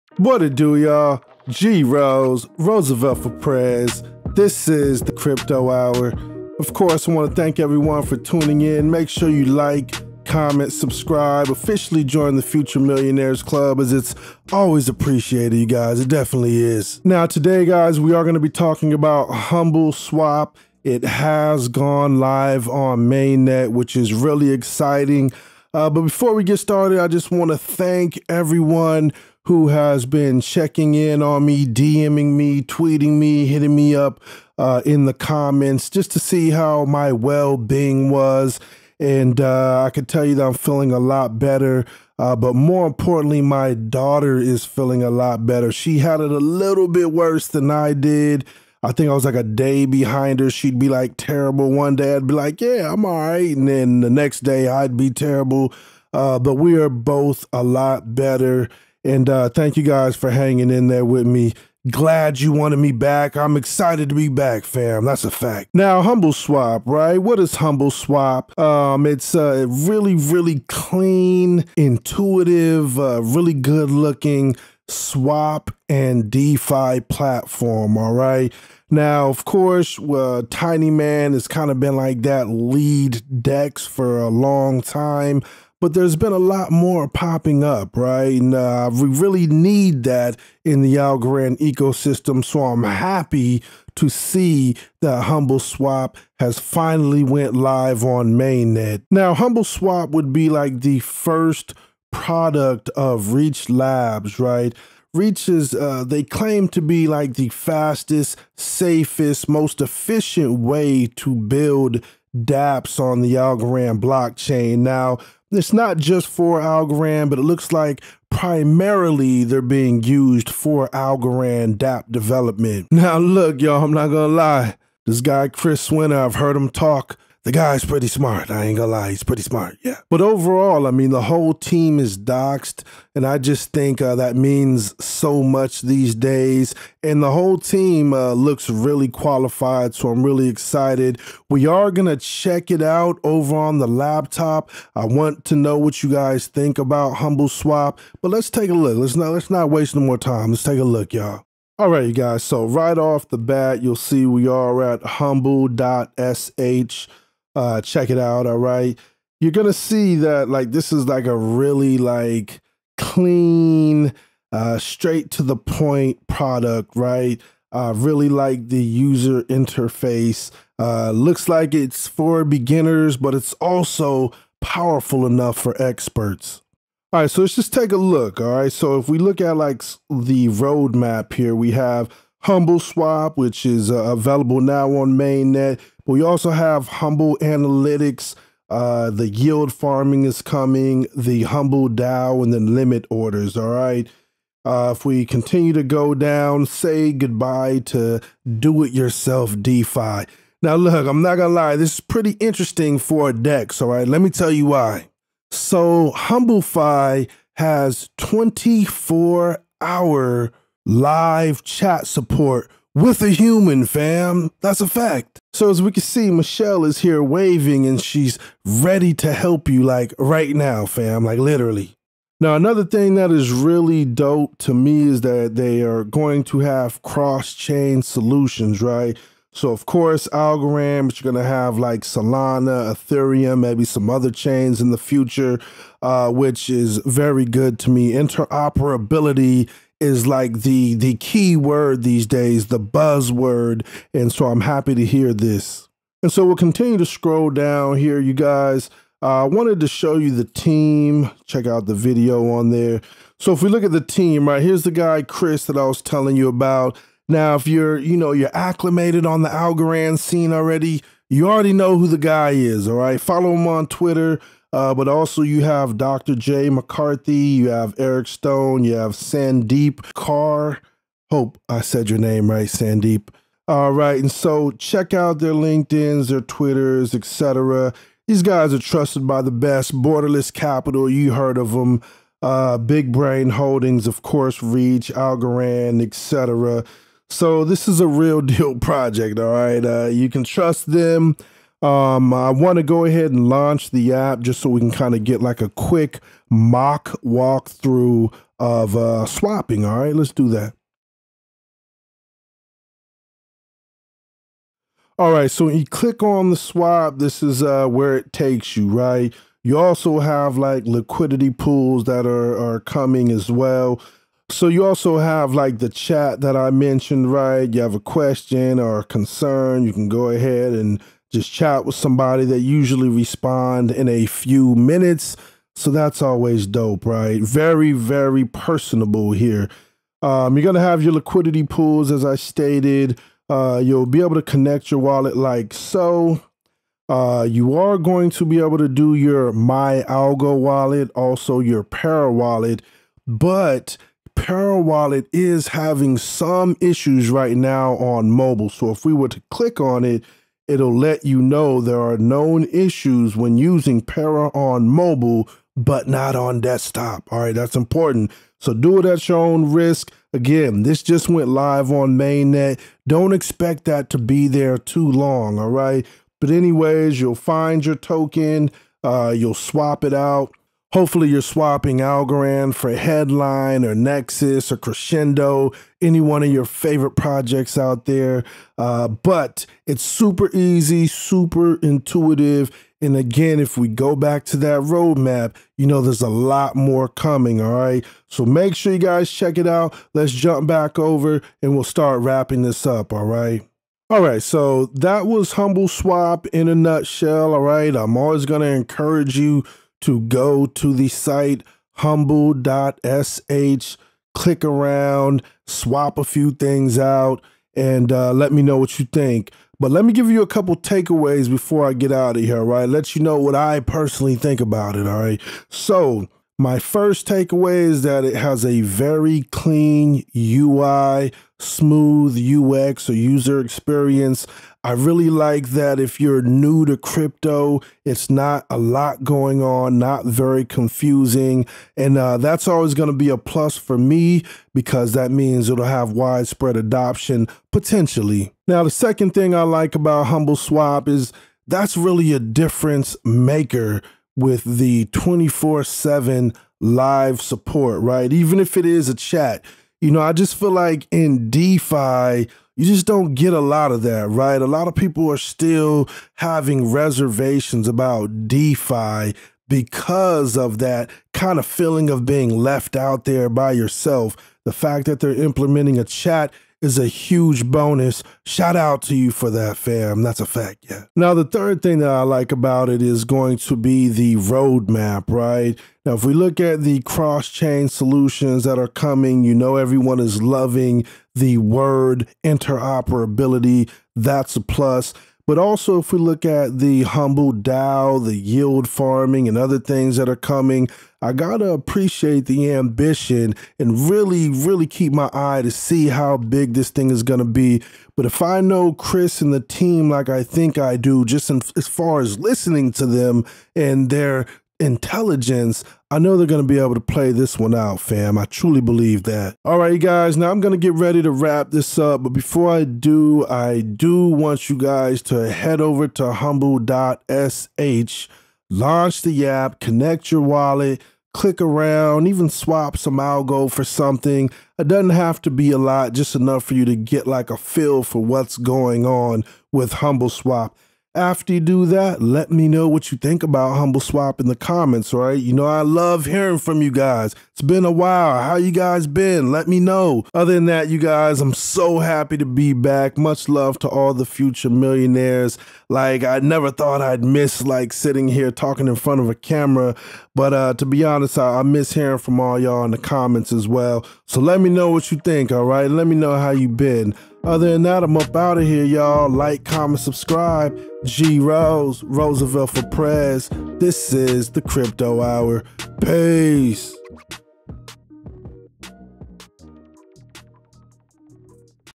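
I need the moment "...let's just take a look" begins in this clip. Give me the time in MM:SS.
02:57.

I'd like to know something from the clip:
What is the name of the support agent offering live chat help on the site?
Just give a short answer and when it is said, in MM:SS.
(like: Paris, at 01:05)
Michelle, at 03:36.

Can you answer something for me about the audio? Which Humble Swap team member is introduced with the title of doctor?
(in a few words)
Jay McCarthy.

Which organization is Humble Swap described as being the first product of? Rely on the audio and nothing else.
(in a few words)
Reach Labs.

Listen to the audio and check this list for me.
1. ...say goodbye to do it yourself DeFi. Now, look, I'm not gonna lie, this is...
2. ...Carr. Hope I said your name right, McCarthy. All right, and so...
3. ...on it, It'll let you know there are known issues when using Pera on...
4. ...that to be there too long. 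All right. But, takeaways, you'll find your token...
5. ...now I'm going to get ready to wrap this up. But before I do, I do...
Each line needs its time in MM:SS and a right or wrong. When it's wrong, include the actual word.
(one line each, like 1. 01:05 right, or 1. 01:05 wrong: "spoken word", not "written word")
1. 03:16 right
2. 04:30 wrong: "Sandeep", not "McCarthy"
3. 05:49 right
4. 06:03 wrong: "anyways", not "takeaways"
5. 08:30 right.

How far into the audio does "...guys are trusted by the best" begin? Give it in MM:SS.
04:38.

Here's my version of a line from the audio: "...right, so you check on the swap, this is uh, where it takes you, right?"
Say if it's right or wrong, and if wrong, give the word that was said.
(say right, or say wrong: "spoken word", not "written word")
wrong: "click", not "check".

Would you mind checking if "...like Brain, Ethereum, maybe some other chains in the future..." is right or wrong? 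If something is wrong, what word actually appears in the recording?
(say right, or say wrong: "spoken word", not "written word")
wrong: "Solana", not "Brain".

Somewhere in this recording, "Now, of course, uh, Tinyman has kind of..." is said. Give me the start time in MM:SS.
01:18.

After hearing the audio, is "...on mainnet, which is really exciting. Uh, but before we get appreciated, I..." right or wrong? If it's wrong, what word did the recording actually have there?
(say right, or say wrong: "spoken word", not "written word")
wrong: "started", not "appreciated".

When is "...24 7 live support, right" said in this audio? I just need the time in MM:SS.
07:25.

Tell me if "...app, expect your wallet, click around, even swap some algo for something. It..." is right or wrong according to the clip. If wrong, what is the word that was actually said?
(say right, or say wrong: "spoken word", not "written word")
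wrong: "connect", not "expect".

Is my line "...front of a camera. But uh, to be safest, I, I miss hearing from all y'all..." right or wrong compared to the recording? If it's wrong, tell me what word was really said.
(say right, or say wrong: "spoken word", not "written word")
wrong: "honest", not "safest".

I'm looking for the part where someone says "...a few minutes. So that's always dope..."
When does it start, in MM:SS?
05:24.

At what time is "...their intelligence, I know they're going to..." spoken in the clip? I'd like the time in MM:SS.
08:24.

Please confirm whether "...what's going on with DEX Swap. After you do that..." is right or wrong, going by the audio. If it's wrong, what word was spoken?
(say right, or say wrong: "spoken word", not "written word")
wrong: "Humble", not "DEX".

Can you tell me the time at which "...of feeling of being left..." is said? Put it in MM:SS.
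07:41.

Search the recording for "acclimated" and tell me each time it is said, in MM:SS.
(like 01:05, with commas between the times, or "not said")
04:18.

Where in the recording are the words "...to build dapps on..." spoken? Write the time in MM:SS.
01:51.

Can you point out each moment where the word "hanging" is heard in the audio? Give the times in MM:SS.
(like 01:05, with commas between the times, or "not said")
01:00.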